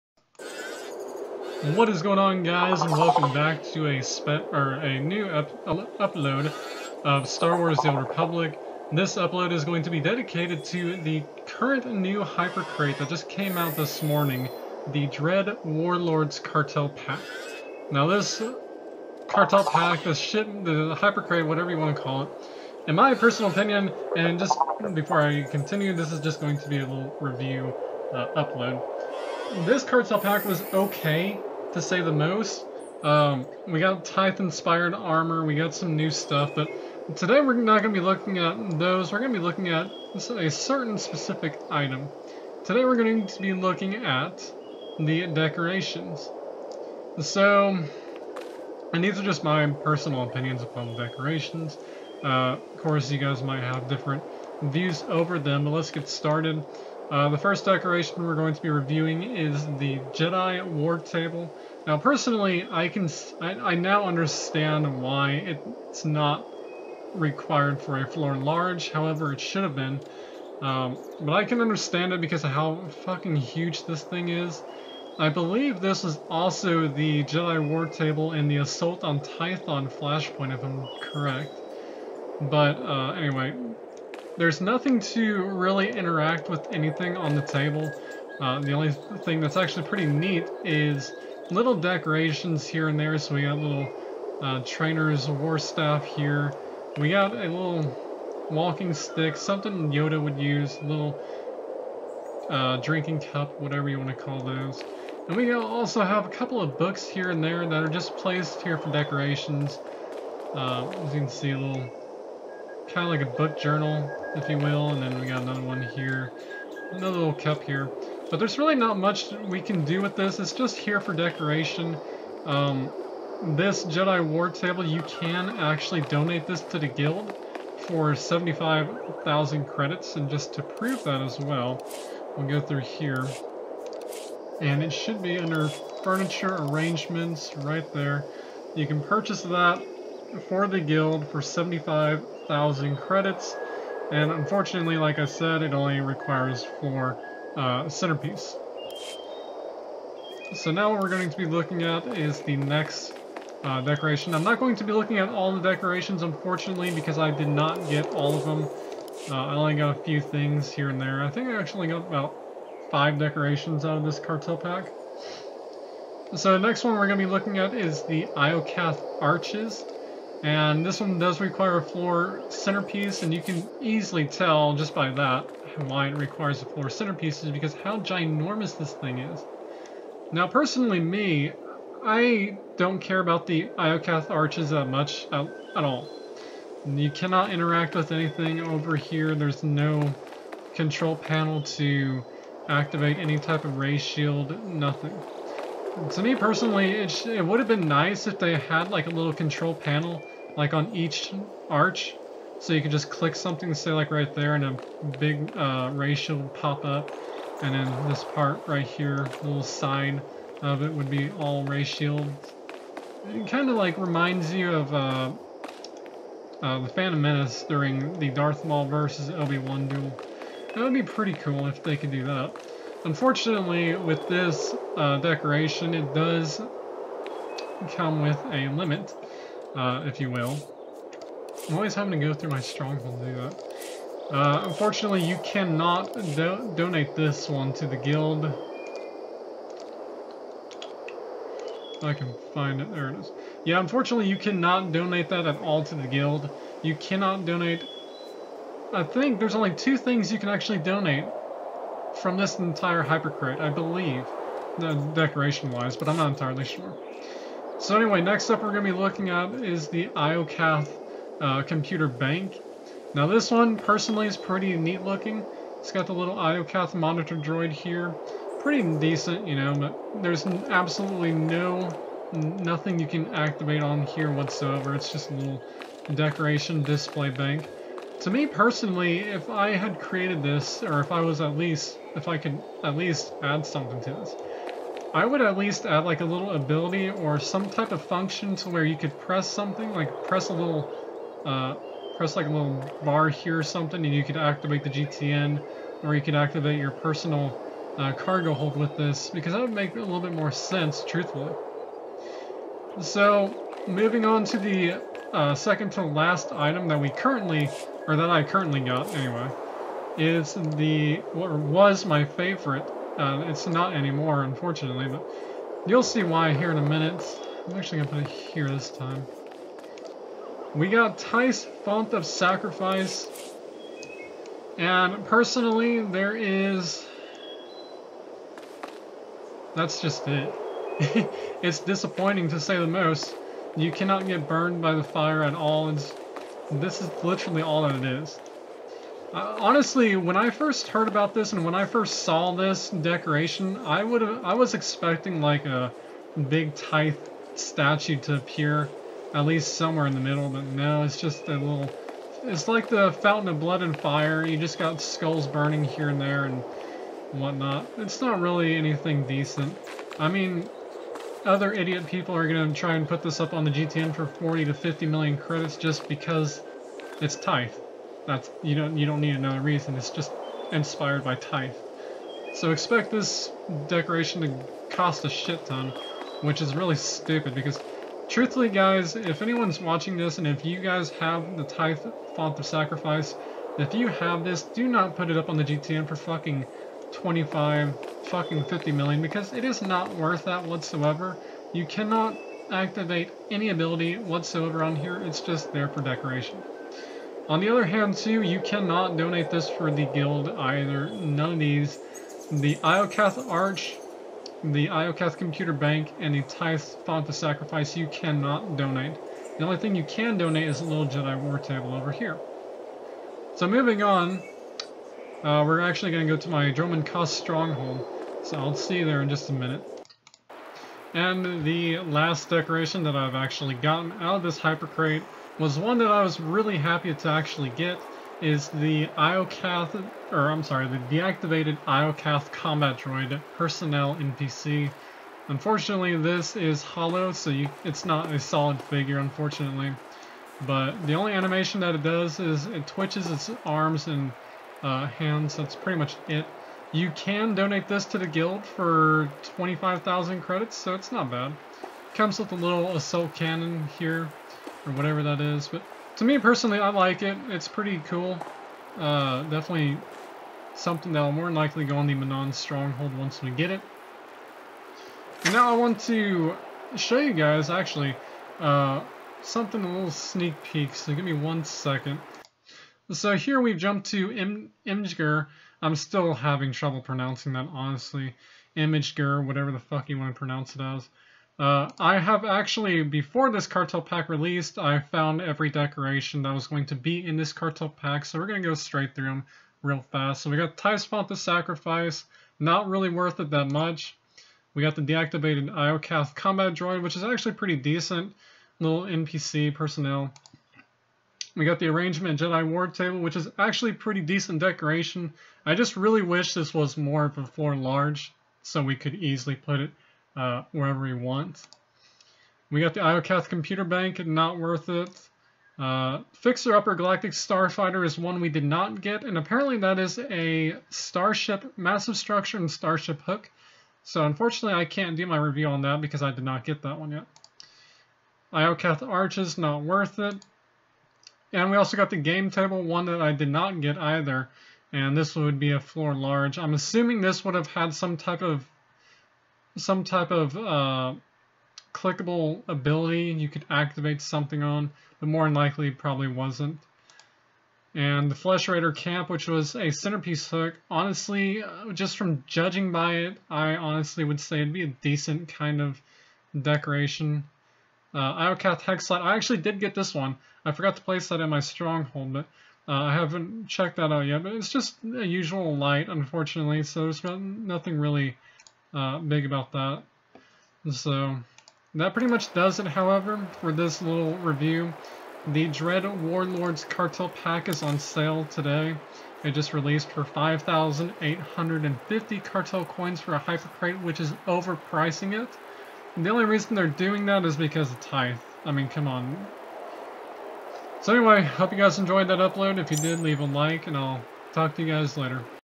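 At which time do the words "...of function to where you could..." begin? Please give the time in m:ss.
4:47.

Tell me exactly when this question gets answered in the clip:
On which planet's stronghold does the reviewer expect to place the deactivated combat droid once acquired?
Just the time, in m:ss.
7:42.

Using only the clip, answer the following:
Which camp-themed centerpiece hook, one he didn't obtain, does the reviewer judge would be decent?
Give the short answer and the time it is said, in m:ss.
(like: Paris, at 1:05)
Flesh Raider camp, at 9:08.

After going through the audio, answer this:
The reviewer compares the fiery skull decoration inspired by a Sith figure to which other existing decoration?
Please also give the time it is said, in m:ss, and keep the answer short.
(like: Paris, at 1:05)
Fountain of Blood and Fire, at 5:53.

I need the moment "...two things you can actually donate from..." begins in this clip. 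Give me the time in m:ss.
4:09.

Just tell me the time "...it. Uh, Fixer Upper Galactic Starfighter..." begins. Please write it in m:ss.
8:34.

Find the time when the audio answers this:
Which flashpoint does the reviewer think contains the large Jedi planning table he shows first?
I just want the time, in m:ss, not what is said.
1:18.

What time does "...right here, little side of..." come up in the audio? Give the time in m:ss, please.
3:28.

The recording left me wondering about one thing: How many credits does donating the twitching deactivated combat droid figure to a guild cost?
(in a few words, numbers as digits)
25,000 credits.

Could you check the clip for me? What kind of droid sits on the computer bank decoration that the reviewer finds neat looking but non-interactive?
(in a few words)
Iokath monitor droid.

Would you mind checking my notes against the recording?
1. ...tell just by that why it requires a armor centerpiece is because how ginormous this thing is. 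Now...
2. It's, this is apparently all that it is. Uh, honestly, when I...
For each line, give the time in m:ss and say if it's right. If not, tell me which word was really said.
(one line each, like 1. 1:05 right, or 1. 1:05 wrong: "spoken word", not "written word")
1. 2:54 wrong: "floor", not "armor"
2. 5:35 wrong: "literally", not "apparently".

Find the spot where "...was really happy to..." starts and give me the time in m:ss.
7:06.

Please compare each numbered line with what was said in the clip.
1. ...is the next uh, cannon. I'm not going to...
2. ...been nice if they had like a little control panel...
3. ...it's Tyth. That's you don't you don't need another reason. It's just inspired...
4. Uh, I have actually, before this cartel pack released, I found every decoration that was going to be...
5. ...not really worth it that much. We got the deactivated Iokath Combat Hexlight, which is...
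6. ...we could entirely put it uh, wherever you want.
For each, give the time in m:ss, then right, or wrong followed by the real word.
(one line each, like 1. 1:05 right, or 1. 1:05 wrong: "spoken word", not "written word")
1. 2:32 wrong: "decoration", not "cannon"
2. 3:17 right
3. 6:07 right
4. 8:01 right
5. 8:12 wrong: "Droid", not "Hexlight"
6. 8:28 wrong: "easily", not "entirely".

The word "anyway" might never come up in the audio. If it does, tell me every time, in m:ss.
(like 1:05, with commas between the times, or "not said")
1:23, 4:17, 5:09, 9:51.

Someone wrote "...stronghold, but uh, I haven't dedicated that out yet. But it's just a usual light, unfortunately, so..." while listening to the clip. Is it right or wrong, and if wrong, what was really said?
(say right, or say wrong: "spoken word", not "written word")
wrong: "checked", not "dedicated".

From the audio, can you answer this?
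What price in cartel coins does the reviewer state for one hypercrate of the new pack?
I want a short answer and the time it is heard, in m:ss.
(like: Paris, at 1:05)
5,850 cartel coins, at 9:40.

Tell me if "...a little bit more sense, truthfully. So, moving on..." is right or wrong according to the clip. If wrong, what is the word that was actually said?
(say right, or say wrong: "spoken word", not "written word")
right.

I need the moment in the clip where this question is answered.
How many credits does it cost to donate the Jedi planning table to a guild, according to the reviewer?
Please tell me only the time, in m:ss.
2:08.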